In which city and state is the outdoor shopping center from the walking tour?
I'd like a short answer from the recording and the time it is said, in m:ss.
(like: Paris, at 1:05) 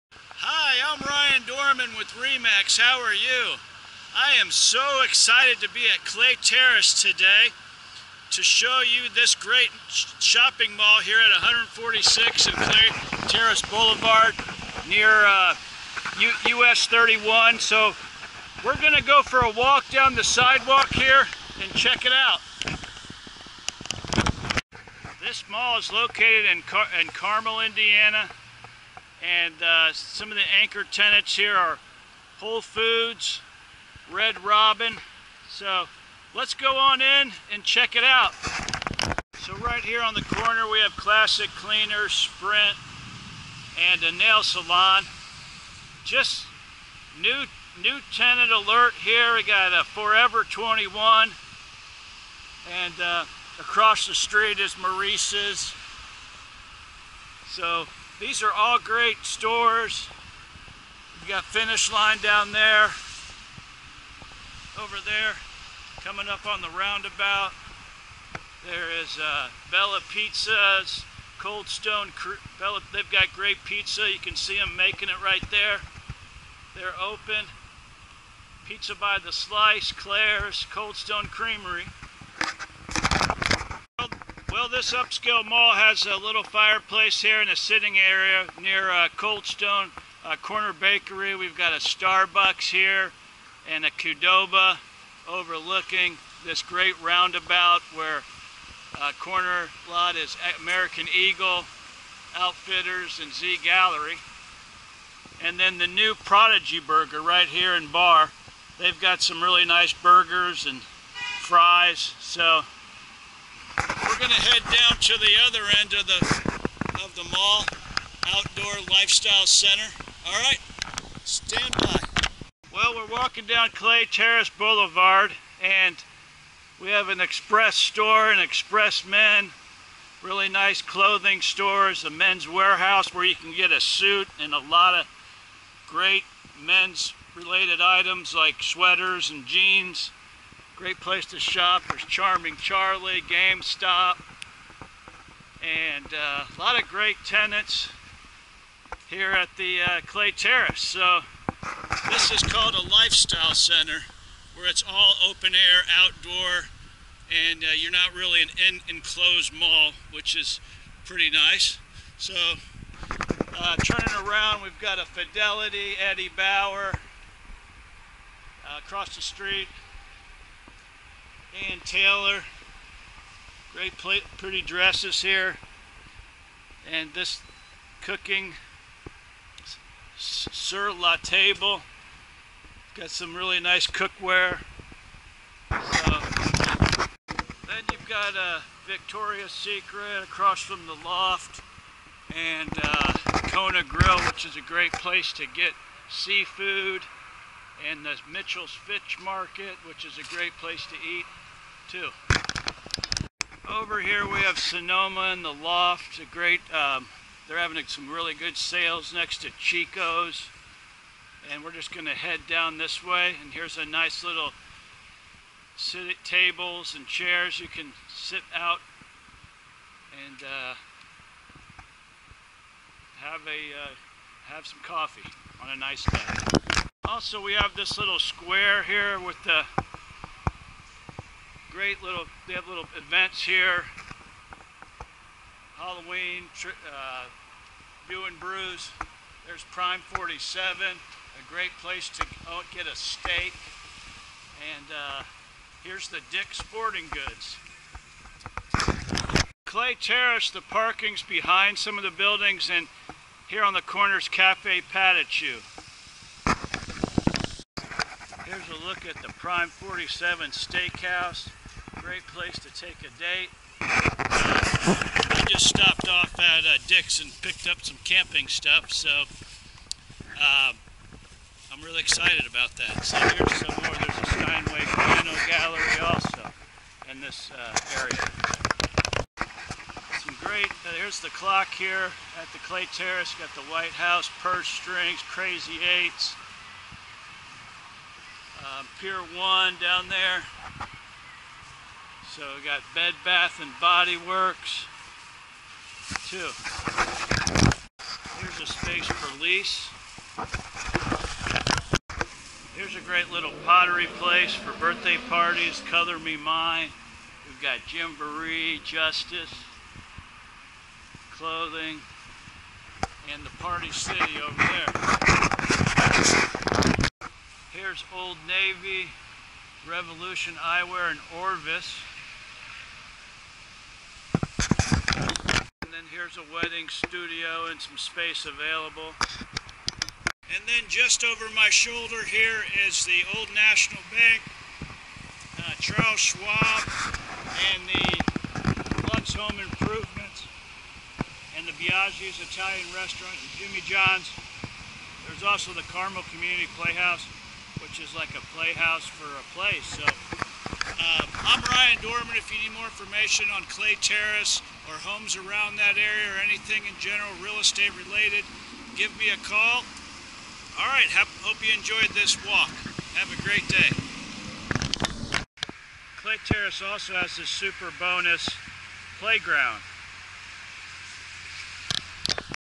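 Carmel, Indiana, at 0:27.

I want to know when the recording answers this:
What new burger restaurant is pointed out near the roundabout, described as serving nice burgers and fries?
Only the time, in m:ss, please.
1:46.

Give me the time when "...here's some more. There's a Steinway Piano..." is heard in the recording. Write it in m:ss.
4:33.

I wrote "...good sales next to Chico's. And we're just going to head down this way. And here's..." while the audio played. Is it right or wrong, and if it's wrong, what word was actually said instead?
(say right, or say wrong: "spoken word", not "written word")
right.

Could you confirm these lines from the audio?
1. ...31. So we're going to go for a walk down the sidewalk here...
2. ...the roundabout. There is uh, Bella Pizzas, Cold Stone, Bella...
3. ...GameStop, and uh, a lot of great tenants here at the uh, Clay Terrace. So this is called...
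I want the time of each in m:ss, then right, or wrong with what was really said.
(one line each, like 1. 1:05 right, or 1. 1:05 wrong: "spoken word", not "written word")
1. 0:16 right
2. 1:06 right
3. 2:23 right.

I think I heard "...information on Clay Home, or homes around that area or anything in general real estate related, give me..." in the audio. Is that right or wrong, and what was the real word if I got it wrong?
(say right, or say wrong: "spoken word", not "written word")
wrong: "Terrace", not "Home".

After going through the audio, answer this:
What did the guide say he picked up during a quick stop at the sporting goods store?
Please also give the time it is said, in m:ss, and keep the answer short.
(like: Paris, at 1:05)
camping stuff, at 4:28.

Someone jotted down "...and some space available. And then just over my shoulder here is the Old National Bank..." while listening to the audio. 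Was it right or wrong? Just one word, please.
right.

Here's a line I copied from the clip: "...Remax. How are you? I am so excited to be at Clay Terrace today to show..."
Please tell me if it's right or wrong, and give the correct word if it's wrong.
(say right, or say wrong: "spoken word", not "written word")
right.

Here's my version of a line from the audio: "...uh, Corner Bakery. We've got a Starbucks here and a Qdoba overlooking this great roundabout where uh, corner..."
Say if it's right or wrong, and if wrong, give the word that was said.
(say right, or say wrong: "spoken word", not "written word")
right.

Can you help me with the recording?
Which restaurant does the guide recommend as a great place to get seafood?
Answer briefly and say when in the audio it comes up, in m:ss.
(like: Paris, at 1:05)
Kona Grill, at 3:13.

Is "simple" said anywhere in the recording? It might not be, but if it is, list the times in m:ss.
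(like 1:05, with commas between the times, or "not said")
not said.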